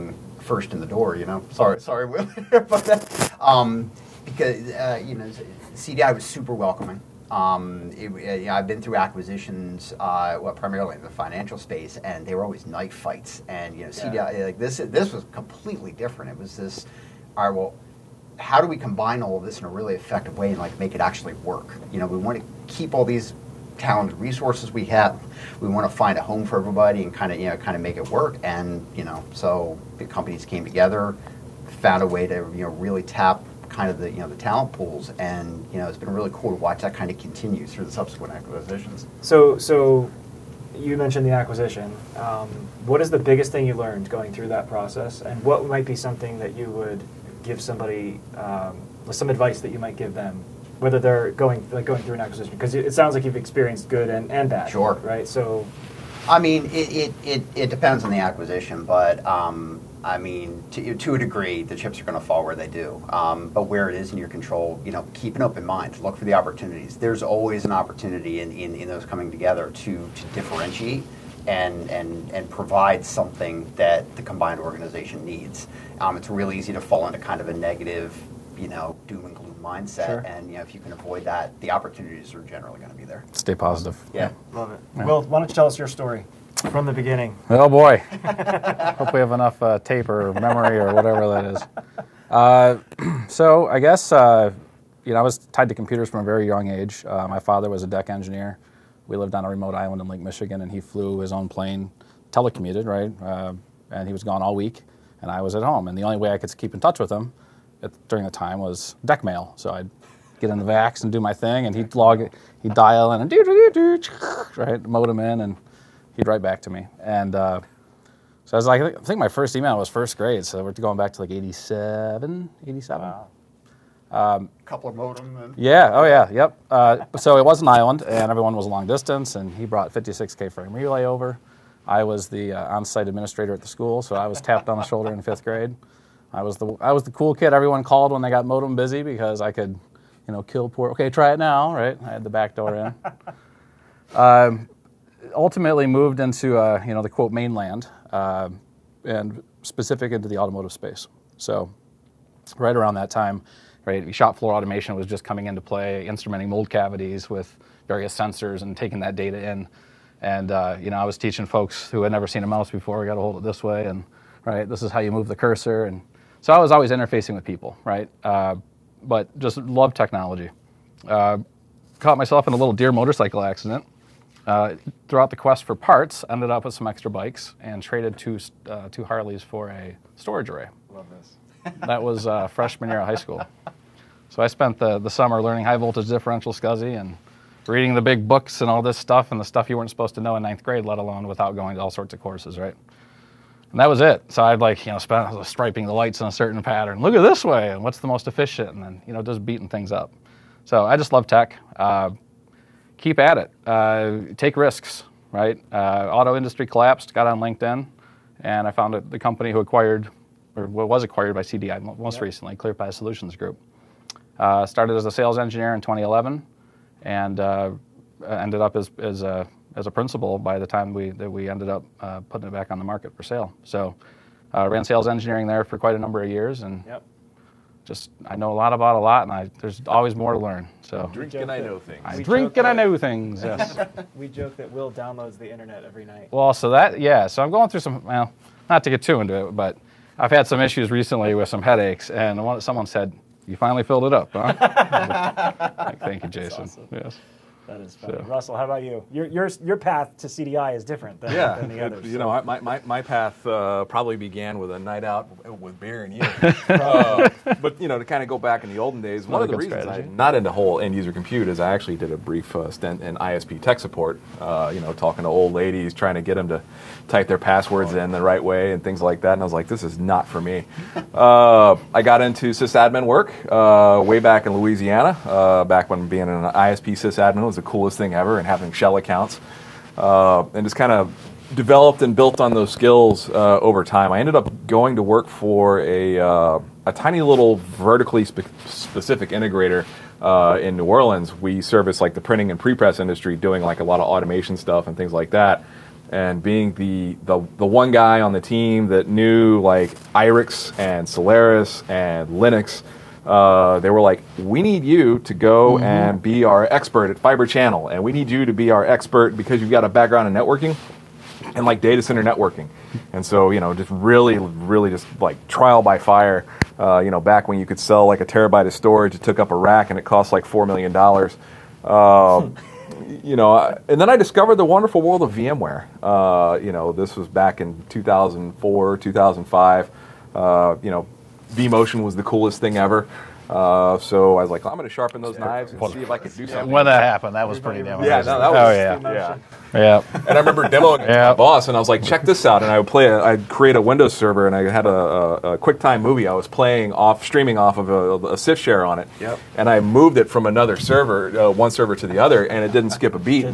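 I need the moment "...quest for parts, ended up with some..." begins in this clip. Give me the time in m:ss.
2:55.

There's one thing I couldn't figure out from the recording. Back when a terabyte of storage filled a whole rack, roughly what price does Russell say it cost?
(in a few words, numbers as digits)
$4 million.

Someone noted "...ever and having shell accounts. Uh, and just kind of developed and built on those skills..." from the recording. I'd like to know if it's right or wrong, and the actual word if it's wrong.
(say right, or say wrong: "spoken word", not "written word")
right.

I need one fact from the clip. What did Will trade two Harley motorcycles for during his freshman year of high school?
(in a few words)
A storage array.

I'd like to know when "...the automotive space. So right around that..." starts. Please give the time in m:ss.
2:30.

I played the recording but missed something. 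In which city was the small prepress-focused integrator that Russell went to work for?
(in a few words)
New Orleans.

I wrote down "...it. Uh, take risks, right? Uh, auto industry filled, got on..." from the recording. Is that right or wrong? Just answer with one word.
wrong.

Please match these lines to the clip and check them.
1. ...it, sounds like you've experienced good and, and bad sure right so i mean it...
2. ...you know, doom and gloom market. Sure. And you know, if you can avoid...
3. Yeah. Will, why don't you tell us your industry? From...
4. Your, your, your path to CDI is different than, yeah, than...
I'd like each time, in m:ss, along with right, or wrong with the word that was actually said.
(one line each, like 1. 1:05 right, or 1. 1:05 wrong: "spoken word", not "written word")
1. 0:52 right
2. 1:18 wrong: "mindset", not "market"
3. 1:24 wrong: "story", not "industry"
4. 4:09 right.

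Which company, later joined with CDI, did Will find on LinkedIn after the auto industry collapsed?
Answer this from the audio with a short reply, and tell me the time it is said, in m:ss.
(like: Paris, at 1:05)
ClearPath Solutions Group, at 3:32.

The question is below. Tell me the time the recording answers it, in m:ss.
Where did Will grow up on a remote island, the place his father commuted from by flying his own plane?
1:40.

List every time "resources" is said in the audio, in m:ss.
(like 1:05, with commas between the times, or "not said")
0:24.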